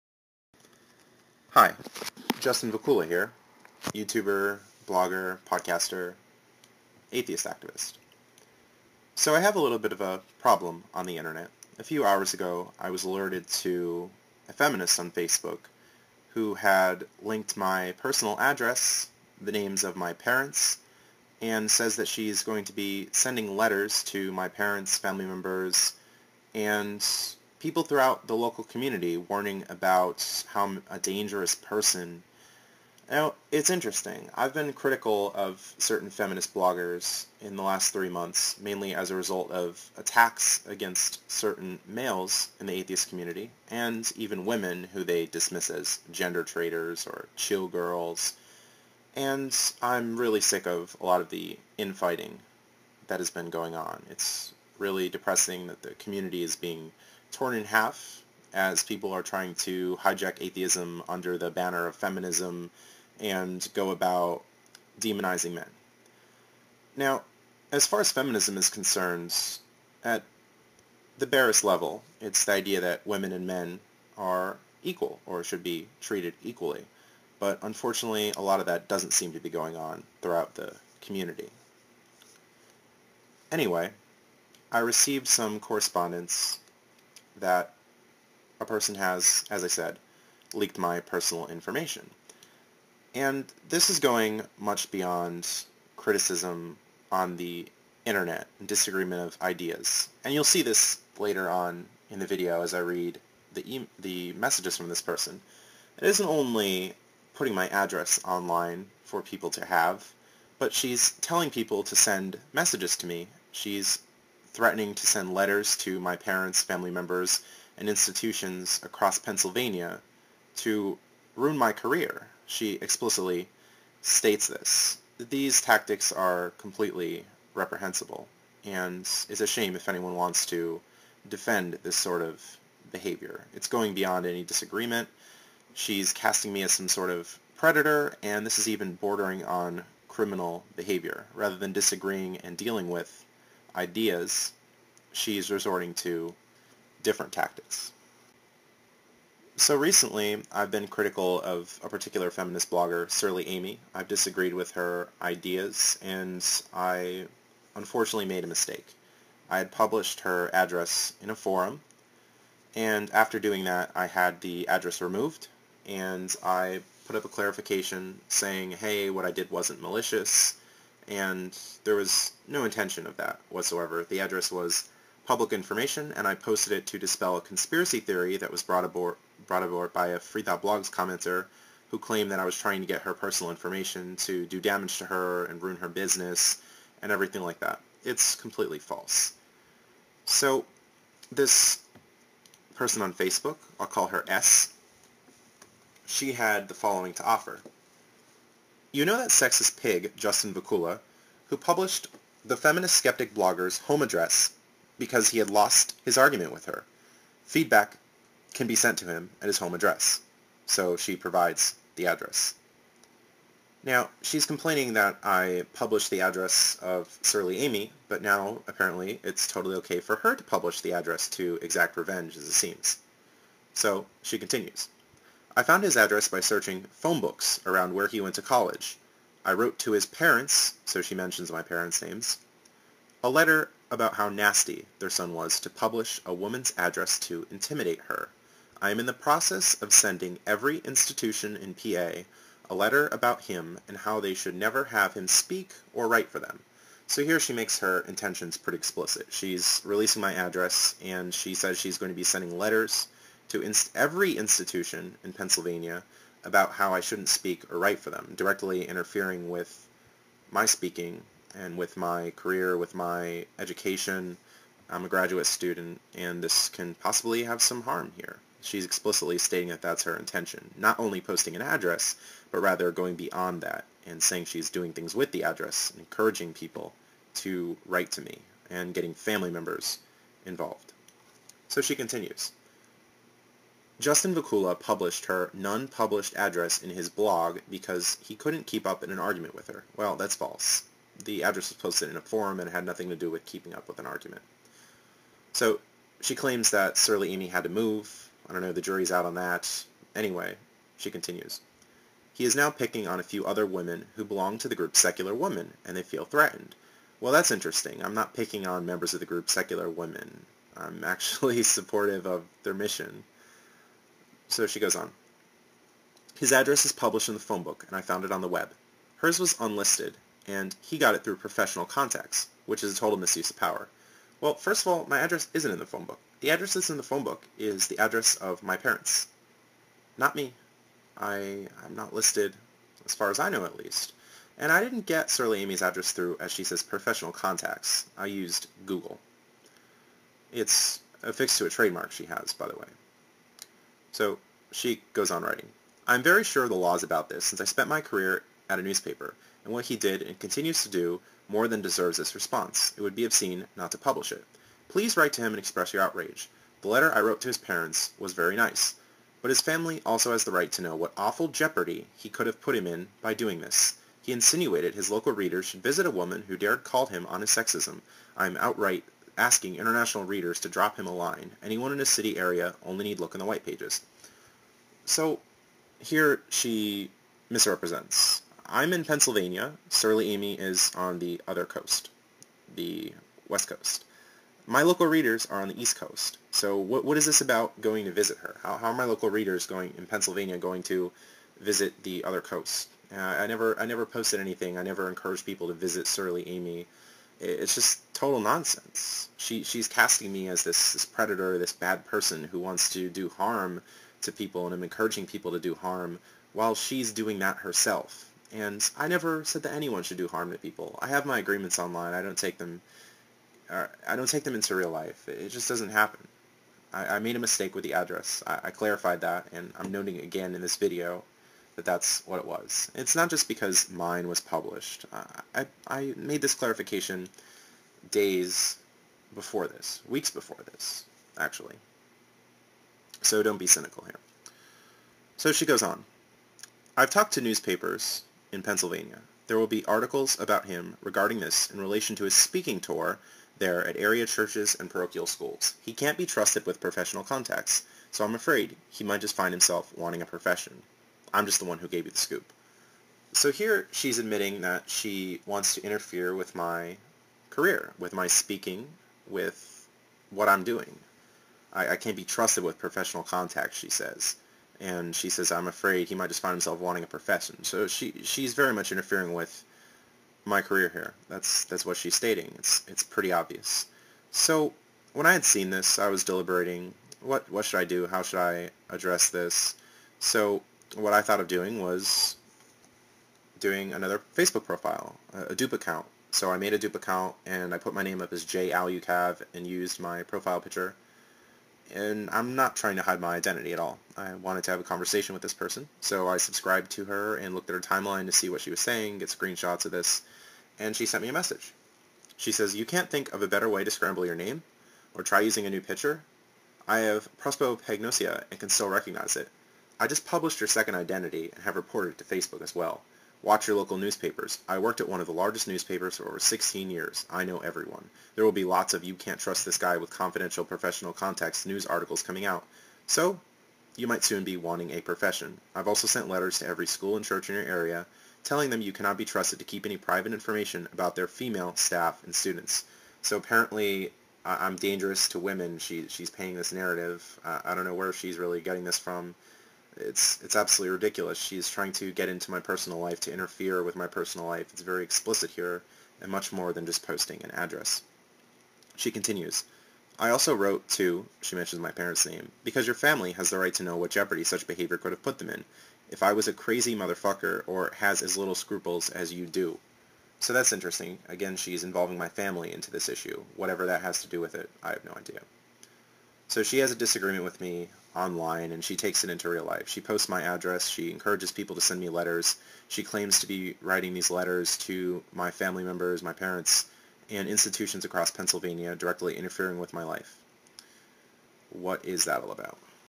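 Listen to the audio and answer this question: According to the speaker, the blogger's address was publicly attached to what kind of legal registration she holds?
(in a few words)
a trademark.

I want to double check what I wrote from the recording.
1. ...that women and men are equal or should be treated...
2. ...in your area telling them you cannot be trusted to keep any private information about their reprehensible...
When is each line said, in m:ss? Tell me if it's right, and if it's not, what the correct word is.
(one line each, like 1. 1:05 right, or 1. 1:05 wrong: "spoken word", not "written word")
1. 1:12 right
2. 8:47 wrong: "female", not "reprehensible".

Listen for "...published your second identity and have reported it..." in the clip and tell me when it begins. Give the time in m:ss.
8:30.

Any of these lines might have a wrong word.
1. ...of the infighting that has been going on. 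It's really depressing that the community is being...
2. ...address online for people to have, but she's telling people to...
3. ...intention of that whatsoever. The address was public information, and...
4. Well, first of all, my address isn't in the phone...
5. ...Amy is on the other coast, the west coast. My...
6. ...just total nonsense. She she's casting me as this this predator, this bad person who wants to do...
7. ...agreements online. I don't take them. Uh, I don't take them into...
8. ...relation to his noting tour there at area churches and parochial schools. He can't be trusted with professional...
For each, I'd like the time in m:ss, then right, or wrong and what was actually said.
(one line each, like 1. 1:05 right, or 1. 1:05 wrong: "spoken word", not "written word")
1. 0:51 right
2. 1:47 right
3. 2:52 right
4. 5:24 right
5. 6:20 right
6. 6:37 right
7. 6:51 right
8. 7:21 wrong: "speaking", not "noting".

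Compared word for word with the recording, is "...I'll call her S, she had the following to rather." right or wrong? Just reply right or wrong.
wrong.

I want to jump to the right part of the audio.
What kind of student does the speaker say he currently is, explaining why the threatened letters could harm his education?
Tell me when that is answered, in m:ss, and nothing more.
4:25.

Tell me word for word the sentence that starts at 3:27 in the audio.
Feedback can be sent to him at his home address, so she provides the address.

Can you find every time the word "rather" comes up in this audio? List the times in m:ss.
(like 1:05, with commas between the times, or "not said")
2:21, 4:32.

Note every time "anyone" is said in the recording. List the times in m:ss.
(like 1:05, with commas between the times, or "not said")
2:09, 6:11, 6:49.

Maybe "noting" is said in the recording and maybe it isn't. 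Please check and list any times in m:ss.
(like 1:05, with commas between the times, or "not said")
6:59.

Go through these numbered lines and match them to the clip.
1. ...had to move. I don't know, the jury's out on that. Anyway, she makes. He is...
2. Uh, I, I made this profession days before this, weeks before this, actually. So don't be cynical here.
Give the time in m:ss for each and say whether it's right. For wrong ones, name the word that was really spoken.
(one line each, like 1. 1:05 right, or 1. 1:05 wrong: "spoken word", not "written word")
1. 4:57 wrong: "continues", not "makes"
2. 7:05 wrong: "clarification", not "profession".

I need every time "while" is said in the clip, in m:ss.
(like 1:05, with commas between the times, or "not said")
6:46.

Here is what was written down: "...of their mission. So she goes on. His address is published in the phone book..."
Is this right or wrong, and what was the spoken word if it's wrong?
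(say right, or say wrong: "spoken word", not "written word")
right.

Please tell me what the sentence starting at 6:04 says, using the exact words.
He insinuated his local readers should visit a woman who dared call him on his sexism.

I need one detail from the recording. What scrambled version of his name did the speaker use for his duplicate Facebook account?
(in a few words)
J. Alucav.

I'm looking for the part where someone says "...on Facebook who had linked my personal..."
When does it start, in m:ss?
0:14.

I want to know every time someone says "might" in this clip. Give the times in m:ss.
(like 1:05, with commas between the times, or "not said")
7:29, 7:46, 8:44.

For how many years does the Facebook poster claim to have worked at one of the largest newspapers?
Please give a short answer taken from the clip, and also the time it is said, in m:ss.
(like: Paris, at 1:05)
16, at 8:36.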